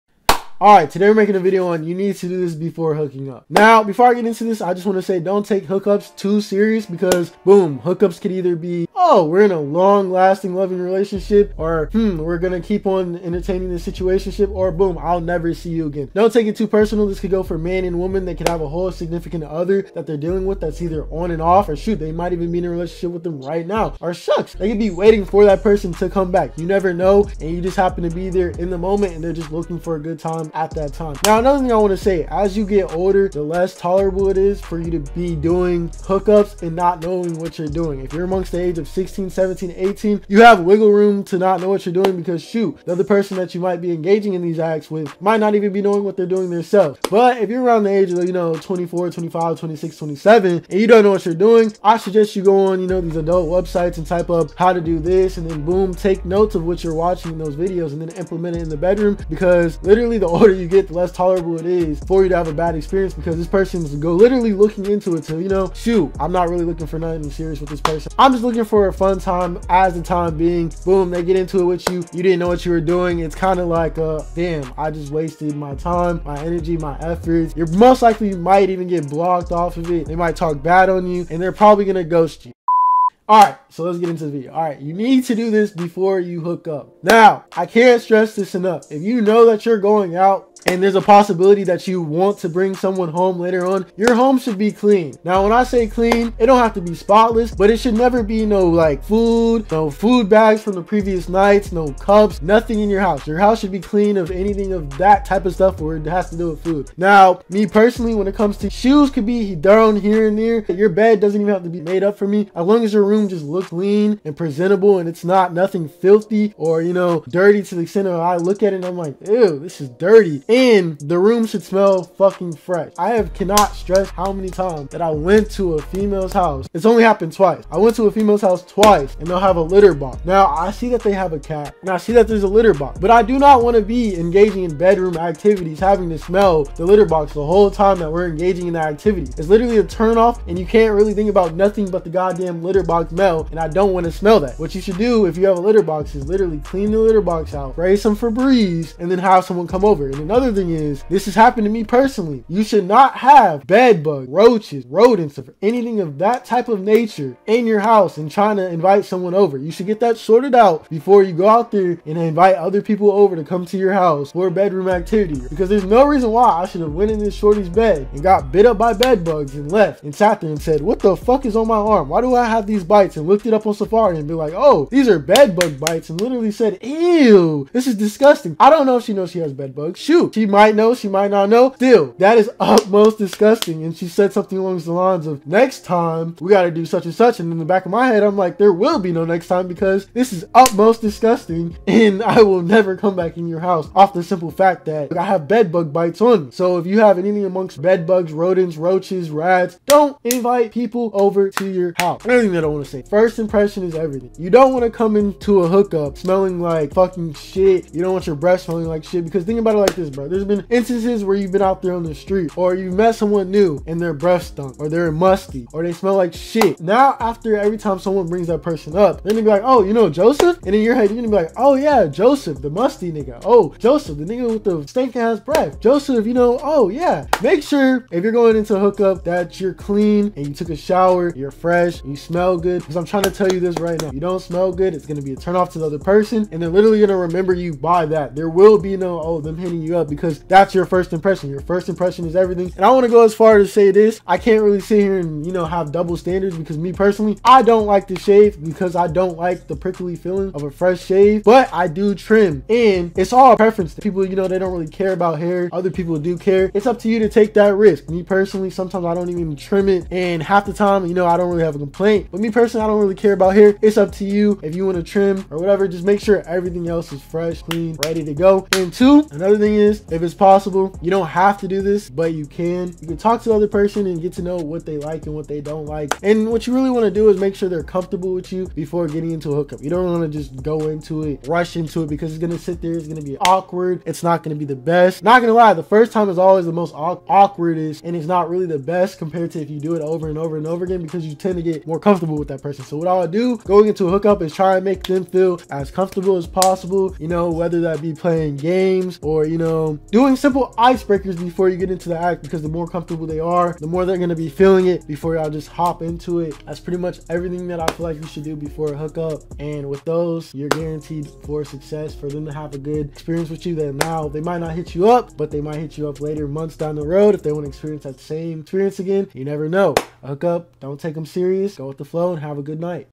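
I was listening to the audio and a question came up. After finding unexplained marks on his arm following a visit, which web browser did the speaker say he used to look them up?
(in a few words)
Safari.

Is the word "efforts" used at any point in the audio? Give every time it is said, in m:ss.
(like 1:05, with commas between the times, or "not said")
1:16.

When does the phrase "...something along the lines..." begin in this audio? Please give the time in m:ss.
3:04.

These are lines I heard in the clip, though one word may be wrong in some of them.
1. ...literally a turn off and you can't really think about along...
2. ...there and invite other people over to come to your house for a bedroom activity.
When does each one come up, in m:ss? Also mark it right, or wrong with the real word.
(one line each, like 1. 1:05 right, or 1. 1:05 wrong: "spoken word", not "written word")
1. 2:19 wrong: "nothing", not "along"
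2. 2:41 right.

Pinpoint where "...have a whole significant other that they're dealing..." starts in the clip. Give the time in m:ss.
0:18.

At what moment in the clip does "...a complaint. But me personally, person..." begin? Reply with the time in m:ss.
4:21.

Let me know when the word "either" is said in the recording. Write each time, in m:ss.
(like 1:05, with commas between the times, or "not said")
0:08, 0:20.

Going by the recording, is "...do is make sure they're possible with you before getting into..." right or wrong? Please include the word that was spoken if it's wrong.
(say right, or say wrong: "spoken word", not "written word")
wrong: "comfortable", not "possible".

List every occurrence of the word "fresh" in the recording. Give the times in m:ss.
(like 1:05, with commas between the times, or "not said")
2:02, 3:51, 4:10, 4:27.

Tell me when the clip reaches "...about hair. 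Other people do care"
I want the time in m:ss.
4:15.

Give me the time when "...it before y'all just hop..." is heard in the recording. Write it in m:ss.
5:04.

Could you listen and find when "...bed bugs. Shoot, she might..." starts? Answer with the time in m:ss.
2:59.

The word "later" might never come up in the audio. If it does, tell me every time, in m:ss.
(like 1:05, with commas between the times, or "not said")
1:33, 5:16.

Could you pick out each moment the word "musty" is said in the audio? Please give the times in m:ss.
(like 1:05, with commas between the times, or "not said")
3:35, 3:42.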